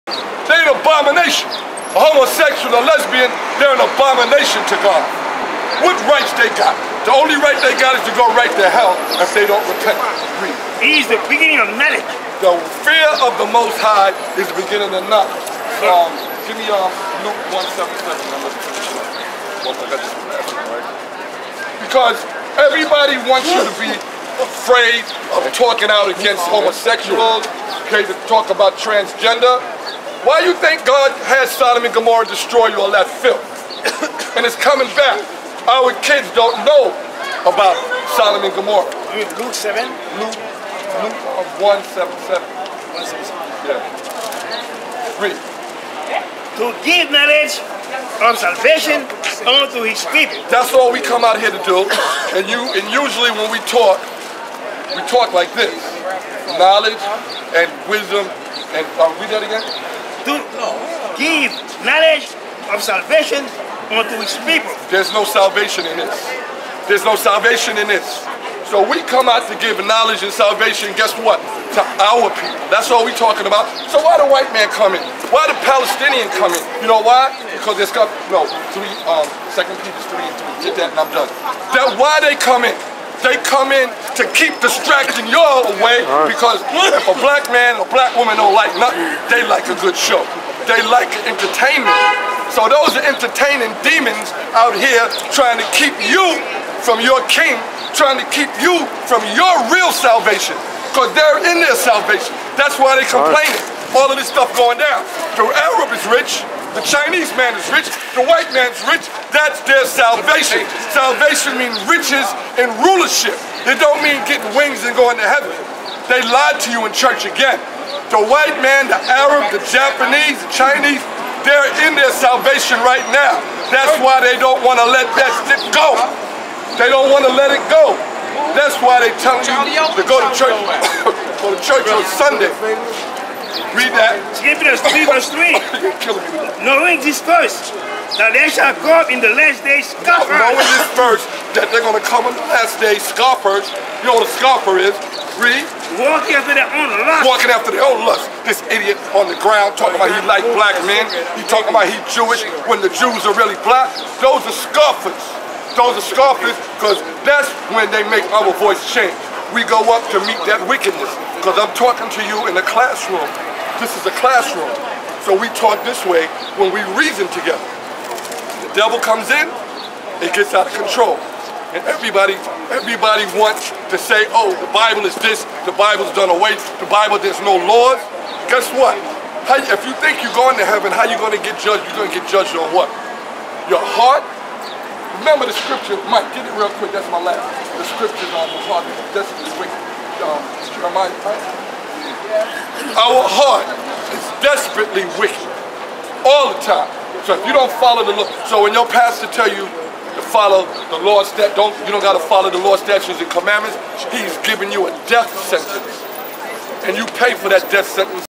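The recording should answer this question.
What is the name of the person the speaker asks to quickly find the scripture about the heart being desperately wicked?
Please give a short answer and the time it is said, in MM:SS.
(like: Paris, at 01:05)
Mike, at 03:06.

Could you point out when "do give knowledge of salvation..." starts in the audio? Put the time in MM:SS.
01:00.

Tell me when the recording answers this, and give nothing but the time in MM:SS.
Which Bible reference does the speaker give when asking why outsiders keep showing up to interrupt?
01:19.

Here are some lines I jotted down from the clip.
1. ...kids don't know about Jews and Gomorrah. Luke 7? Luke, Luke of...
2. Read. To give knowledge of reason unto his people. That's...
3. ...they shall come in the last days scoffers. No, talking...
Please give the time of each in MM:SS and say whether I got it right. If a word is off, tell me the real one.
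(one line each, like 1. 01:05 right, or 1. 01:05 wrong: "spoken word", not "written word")
1. 00:36 wrong: "Sodom", not "Jews"
2. 00:45 wrong: "salvation", not "reason"
3. 02:18 wrong: "knowing", not "talking".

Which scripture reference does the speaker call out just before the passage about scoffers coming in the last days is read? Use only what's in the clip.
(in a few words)
Hebrews 3:3.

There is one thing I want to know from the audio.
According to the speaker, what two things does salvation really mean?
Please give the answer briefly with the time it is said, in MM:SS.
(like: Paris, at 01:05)
Riches and rulership, at 01:51.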